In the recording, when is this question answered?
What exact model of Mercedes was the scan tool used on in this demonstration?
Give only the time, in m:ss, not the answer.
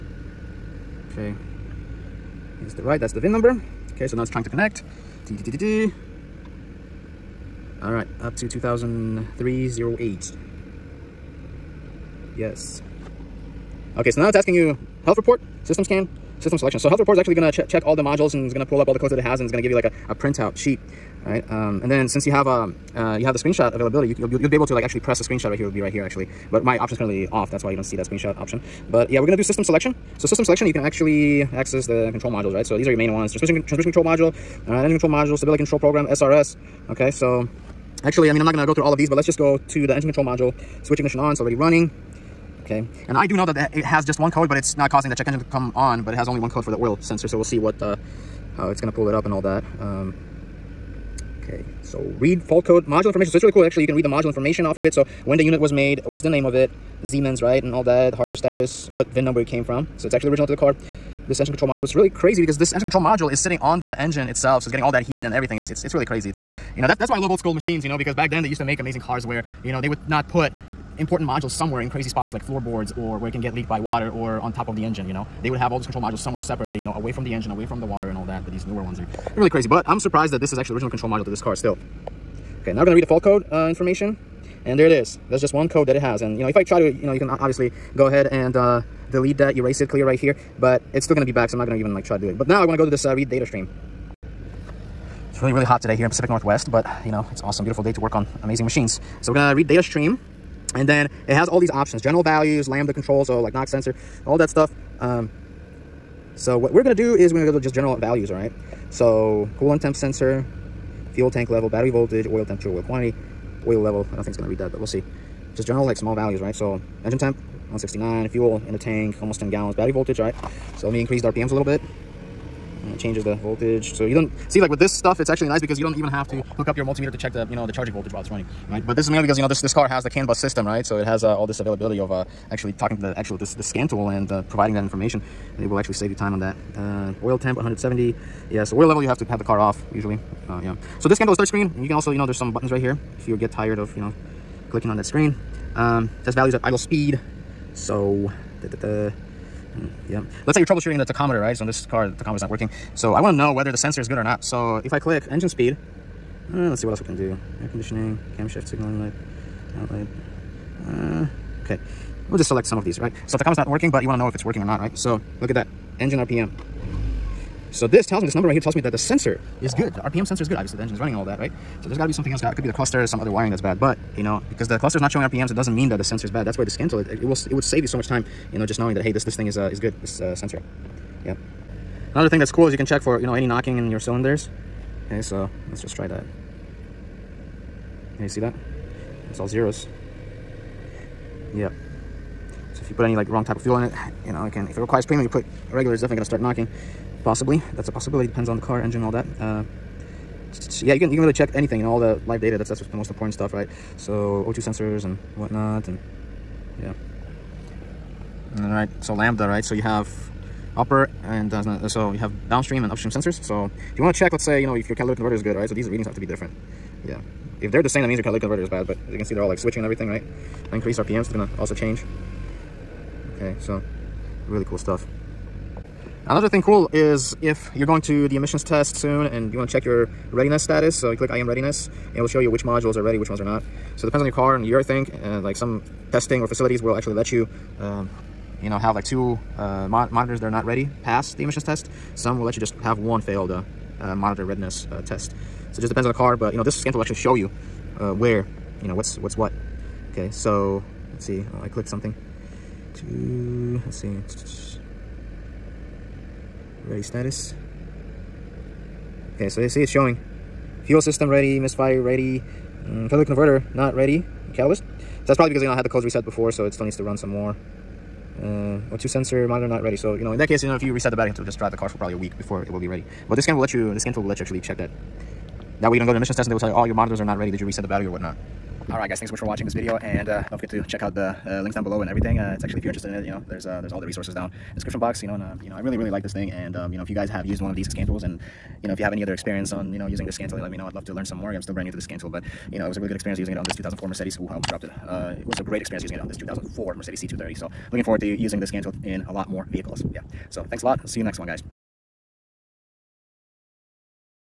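4:57.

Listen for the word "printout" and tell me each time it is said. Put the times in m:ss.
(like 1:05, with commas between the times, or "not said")
0:20.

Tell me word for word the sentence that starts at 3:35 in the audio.
So these readings have to be different.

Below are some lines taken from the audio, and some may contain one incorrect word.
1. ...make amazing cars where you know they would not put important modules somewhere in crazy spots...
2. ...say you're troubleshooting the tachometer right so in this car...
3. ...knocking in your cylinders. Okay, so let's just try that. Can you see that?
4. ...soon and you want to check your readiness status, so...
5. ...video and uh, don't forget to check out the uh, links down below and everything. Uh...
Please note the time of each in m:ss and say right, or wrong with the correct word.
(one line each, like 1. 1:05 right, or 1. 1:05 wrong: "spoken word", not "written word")
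1. 1:08 right
2. 2:30 right
3. 3:03 right
4. 3:48 right
5. 4:39 right.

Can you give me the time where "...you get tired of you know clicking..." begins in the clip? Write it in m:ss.
2:23.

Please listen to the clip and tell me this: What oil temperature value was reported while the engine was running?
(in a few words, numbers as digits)
170.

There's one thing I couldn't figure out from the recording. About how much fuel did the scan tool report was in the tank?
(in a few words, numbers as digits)
almost 10 gallons.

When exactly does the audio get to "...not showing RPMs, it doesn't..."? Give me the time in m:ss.
2:55.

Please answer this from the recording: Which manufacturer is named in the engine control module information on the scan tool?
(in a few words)
Siemens.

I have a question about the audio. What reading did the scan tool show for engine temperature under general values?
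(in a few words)
169.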